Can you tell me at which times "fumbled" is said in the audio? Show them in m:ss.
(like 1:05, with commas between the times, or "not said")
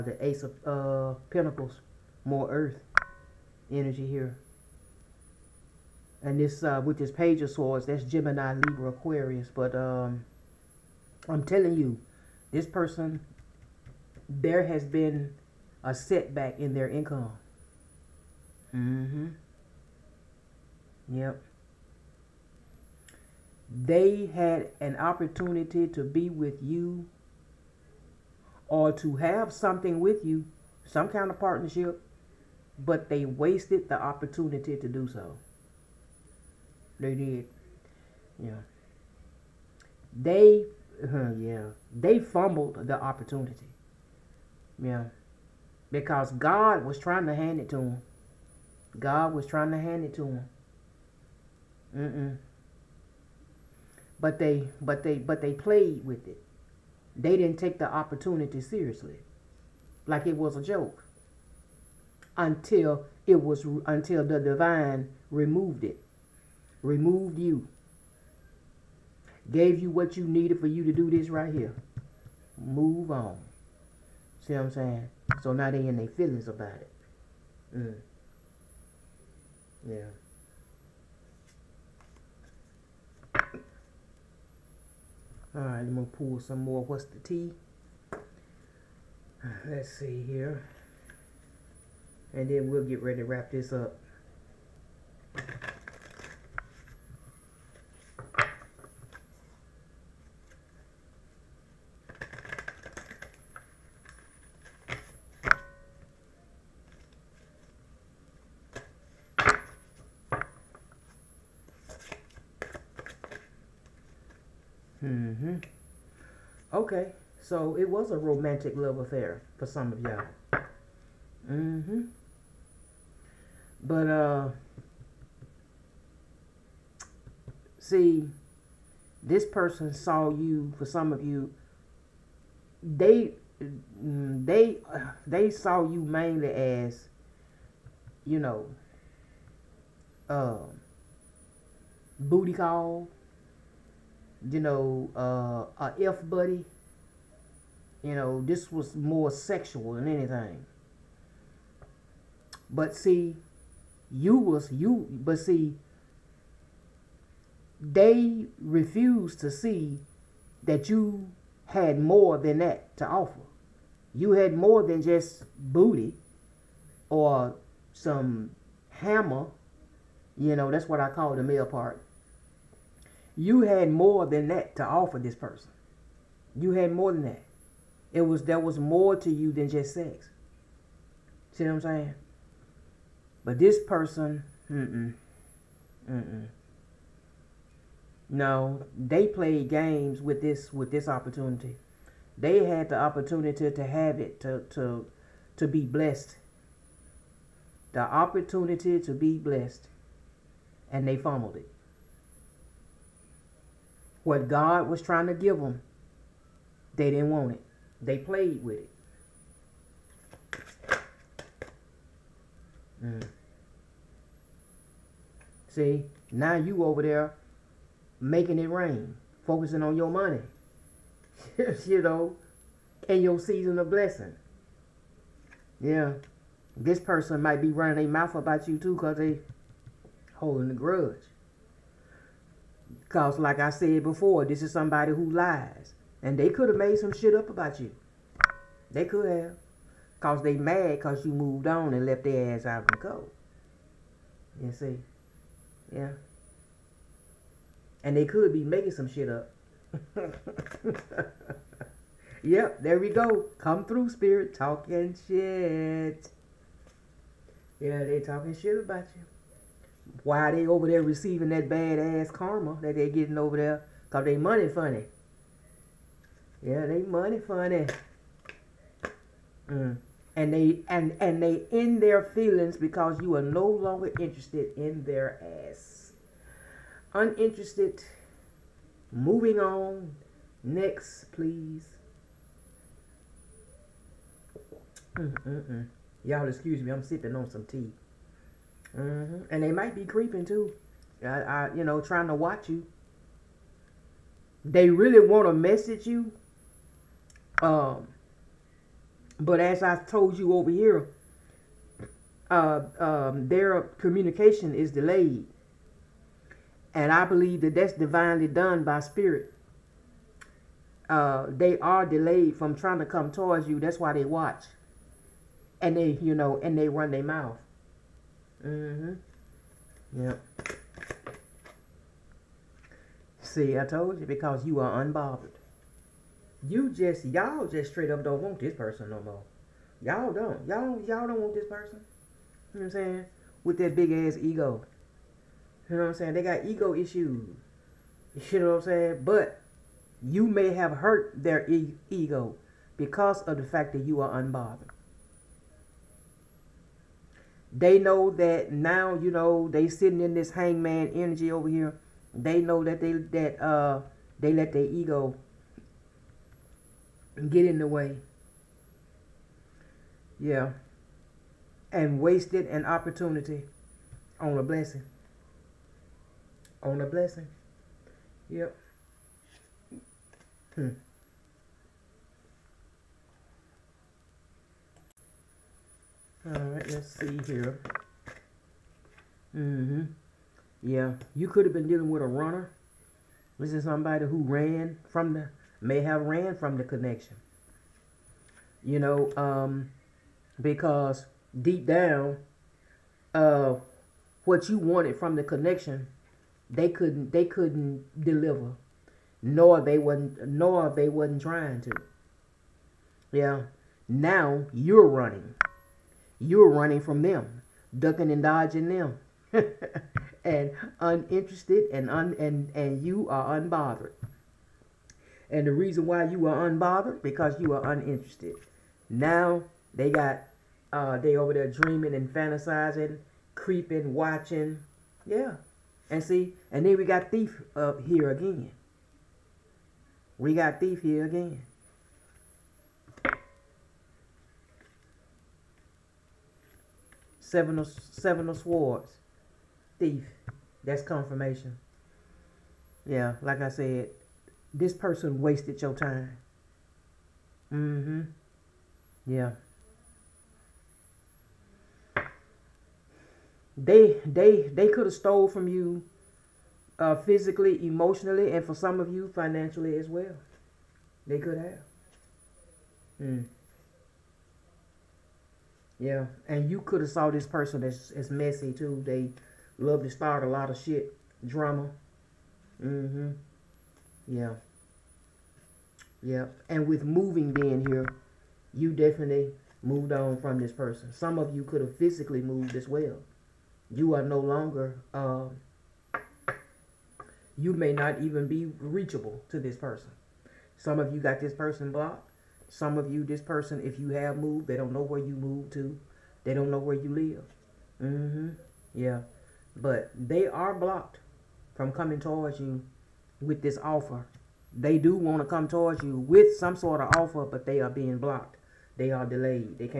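0:42, 3:21.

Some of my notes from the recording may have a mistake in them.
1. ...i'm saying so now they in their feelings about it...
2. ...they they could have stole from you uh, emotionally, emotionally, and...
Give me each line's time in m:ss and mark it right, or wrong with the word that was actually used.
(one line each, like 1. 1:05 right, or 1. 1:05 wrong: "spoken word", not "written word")
1. 1:14 right
2. 7:34 wrong: "physically", not "emotionally".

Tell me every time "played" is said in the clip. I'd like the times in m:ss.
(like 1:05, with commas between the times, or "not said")
0:55, 3:09, 3:28.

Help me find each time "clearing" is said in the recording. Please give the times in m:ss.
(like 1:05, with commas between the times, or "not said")
not said.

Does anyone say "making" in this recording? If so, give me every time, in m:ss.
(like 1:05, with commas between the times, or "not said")
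3:38, 4:08.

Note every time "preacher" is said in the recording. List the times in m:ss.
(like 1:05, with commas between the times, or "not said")
not said.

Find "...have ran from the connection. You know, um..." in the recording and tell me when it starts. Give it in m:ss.
6:25.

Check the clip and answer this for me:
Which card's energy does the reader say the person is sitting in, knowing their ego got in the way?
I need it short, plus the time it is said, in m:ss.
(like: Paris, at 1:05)
hangman, at 5:50.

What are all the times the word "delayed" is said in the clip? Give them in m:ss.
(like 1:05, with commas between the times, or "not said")
5:04, 5:12, 8:29.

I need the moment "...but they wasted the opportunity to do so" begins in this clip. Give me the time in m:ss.
0:32.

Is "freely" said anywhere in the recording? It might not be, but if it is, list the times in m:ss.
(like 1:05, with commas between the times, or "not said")
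not said.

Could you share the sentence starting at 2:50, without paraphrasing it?
You know, that's what I call the male part.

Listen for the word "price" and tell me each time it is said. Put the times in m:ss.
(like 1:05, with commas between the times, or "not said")
not said.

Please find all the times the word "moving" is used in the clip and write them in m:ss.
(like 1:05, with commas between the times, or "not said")
4:39, 7:57.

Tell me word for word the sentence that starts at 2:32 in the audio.
But see, you was you but see they refused to see that you had more than that to offer.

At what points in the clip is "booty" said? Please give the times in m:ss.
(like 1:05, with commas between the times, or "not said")
2:22, 2:45.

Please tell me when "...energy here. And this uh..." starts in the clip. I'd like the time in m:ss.
0:03.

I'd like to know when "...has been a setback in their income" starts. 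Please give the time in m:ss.
0:14.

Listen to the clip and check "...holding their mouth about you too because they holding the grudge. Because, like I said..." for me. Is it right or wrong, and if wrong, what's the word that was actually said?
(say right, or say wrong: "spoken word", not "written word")
wrong: "running", not "holding".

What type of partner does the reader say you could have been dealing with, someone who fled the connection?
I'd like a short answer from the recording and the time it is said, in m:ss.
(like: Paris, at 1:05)
a runner, at 6:22.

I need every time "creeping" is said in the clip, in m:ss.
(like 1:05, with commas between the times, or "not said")
4:50, 7:03.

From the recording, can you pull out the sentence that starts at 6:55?
And the reason why you are unbothered, because you are uninterested.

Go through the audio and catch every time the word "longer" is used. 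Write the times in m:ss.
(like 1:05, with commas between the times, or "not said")
4:33, 8:04.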